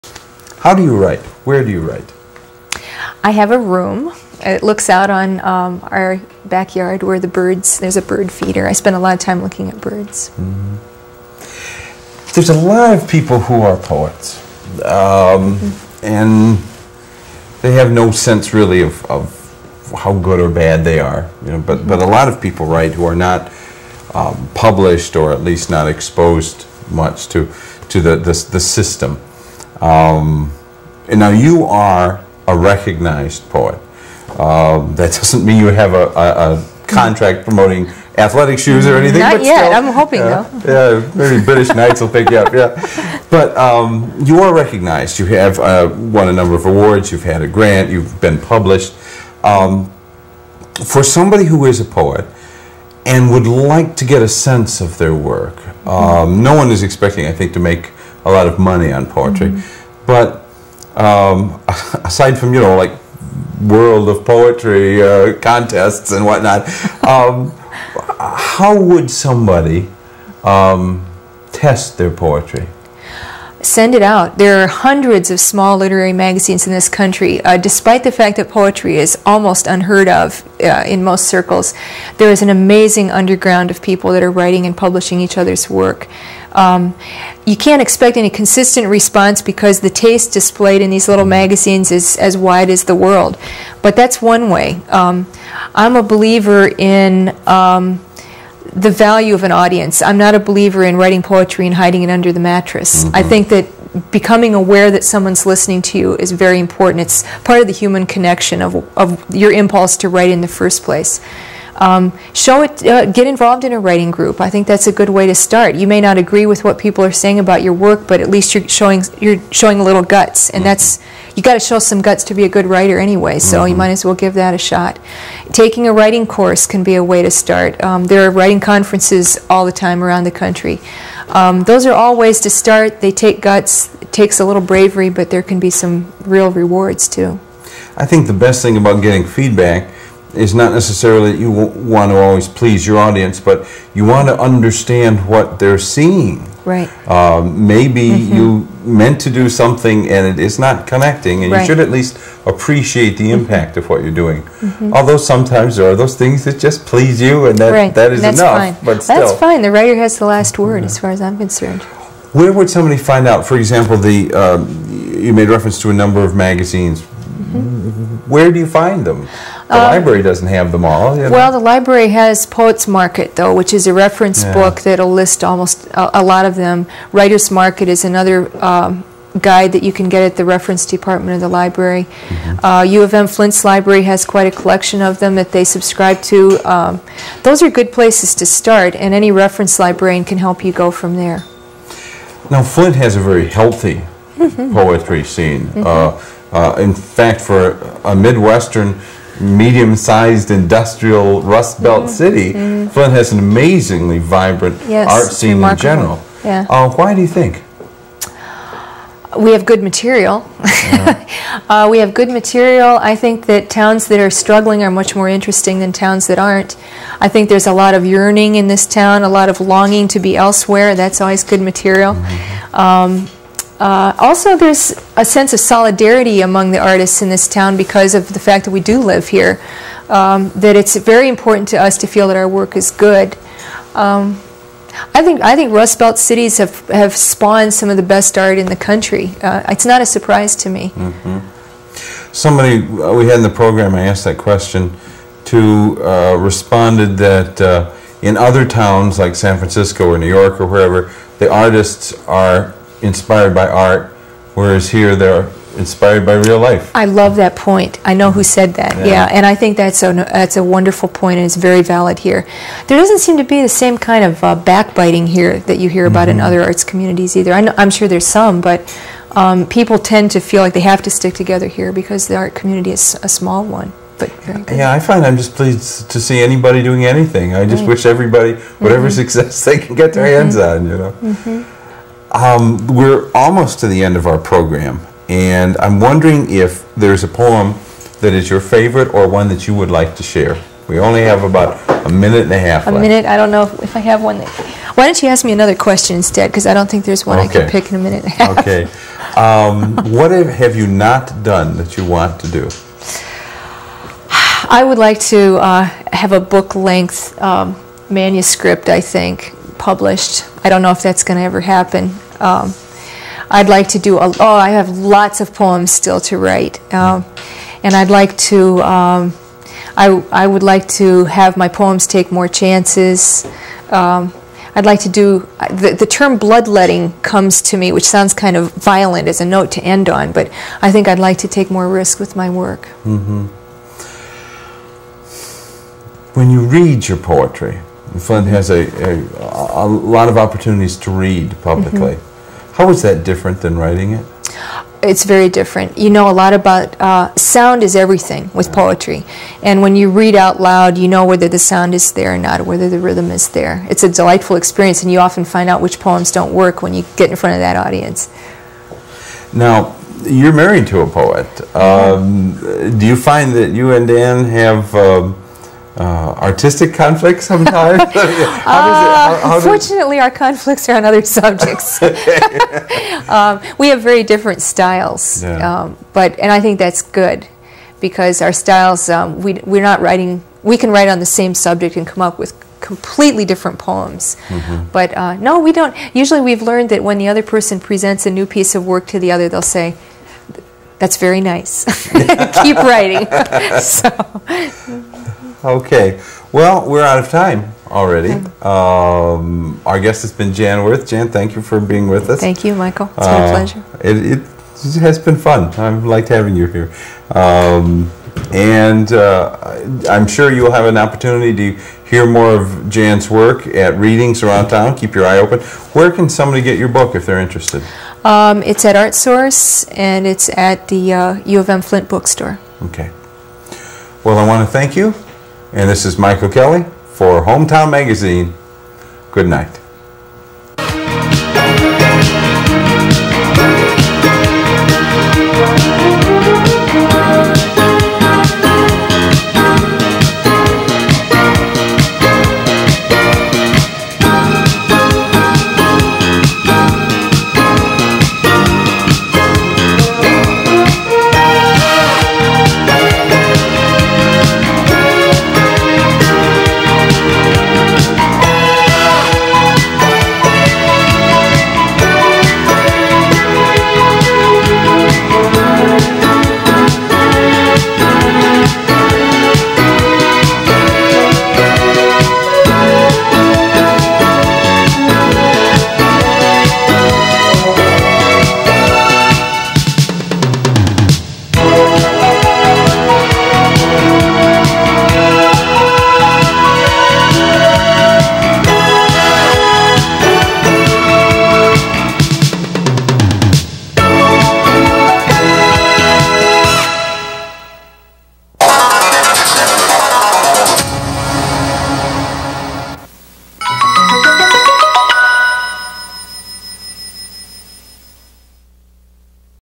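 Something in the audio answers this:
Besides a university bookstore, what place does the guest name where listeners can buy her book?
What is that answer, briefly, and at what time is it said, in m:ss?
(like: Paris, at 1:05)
ArtSource, at 6:58.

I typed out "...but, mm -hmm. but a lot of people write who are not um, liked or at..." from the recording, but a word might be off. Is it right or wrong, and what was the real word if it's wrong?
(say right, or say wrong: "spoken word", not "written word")
wrong: "published", not "liked".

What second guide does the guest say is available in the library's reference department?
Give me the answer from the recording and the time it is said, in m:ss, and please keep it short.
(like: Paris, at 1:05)
Writer's Market, at 2:57.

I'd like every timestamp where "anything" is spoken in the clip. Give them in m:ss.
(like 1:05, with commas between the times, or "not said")
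0:38, 4:37.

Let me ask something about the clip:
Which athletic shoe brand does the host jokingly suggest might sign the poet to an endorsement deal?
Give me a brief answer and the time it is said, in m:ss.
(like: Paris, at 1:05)
British Knights, at 0:41.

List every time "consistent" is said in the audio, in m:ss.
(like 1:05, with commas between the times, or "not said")
1:28.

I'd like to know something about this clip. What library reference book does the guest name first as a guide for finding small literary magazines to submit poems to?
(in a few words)
Poets Market.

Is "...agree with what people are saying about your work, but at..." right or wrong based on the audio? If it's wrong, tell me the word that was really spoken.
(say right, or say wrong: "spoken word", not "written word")
right.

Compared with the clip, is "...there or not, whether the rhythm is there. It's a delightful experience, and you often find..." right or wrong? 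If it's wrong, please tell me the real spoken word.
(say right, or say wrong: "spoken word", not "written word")
right.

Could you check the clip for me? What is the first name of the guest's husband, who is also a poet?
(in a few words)
Dan.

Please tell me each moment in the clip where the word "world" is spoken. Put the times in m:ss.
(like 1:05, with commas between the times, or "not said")
1:03, 1:32.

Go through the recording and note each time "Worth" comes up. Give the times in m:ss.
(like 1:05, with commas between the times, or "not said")
6:40.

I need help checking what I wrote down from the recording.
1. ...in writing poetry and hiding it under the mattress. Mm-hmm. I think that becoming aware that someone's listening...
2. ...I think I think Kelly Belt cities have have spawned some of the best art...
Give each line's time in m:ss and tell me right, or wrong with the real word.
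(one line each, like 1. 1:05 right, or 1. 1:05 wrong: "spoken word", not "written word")
1. 1:40 right
2. 3:55 wrong: "Rust", not "Kelly".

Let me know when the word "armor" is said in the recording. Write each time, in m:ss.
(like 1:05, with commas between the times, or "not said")
not said.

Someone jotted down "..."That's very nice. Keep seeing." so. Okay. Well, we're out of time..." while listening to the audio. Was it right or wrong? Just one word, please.
wrong.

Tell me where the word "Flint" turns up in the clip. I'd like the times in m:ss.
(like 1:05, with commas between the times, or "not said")
3:03, 3:12, 3:22, 7:01.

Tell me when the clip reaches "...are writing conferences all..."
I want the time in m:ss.
2:08.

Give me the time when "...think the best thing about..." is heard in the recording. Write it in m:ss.
2:18.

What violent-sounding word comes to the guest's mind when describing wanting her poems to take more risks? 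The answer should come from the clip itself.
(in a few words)
Bloodletting.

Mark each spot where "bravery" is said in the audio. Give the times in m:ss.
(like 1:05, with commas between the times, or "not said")
2:14.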